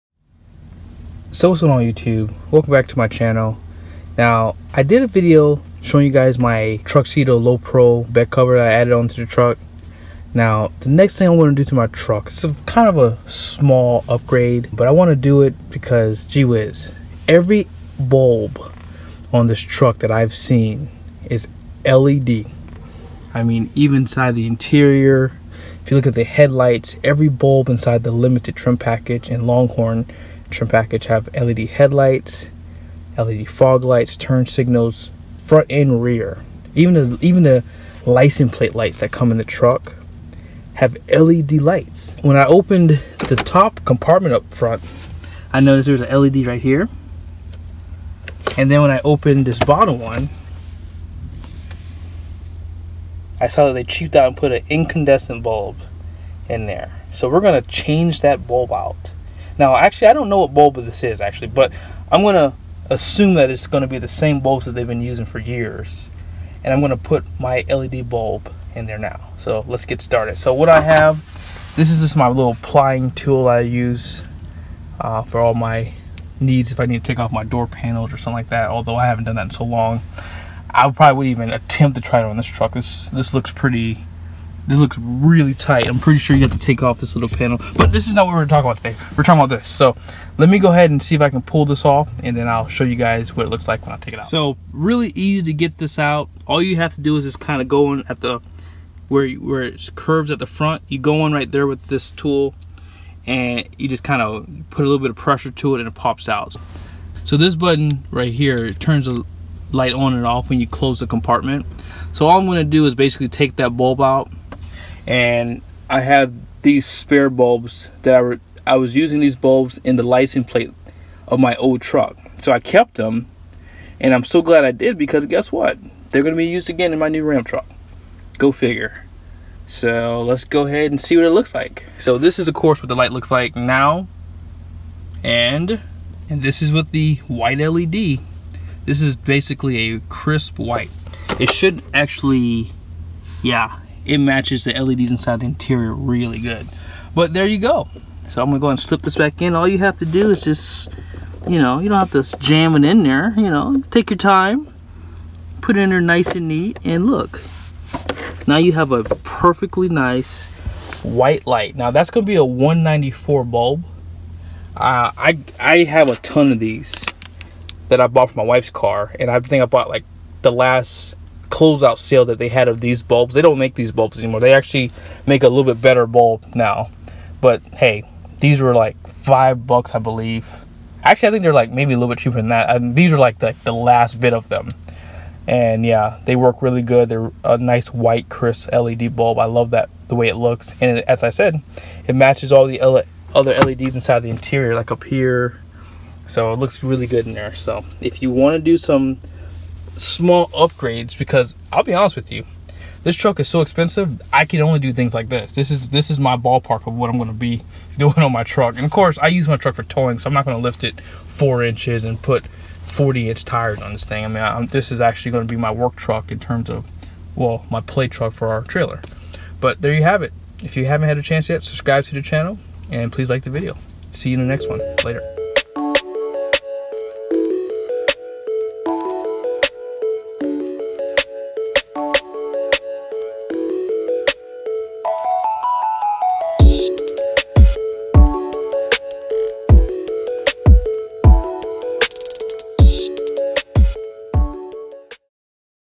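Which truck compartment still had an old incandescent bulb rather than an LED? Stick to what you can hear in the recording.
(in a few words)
bottom one.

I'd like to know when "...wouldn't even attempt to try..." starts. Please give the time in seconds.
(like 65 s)
81 s.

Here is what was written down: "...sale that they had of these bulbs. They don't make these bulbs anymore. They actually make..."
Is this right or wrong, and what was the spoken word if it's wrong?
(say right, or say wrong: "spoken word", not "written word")
right.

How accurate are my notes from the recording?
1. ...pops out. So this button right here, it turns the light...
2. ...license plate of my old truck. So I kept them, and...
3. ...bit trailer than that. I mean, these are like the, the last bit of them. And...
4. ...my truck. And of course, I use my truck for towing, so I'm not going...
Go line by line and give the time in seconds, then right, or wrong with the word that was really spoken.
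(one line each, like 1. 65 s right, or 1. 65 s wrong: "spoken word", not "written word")
1. 105 s right
2. 120 s right
3. 182 s wrong: "cheaper", not "trailer"
4. 208 s right.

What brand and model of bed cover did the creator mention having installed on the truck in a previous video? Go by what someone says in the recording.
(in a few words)
Truxedo Lo Pro.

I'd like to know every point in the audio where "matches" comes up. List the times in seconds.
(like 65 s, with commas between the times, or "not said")
144 s, 192 s.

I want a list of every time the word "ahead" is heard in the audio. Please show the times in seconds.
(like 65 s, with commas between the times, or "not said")
90 s, 130 s.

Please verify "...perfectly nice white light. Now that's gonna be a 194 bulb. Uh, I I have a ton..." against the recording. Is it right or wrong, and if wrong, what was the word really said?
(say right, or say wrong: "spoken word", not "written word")
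right.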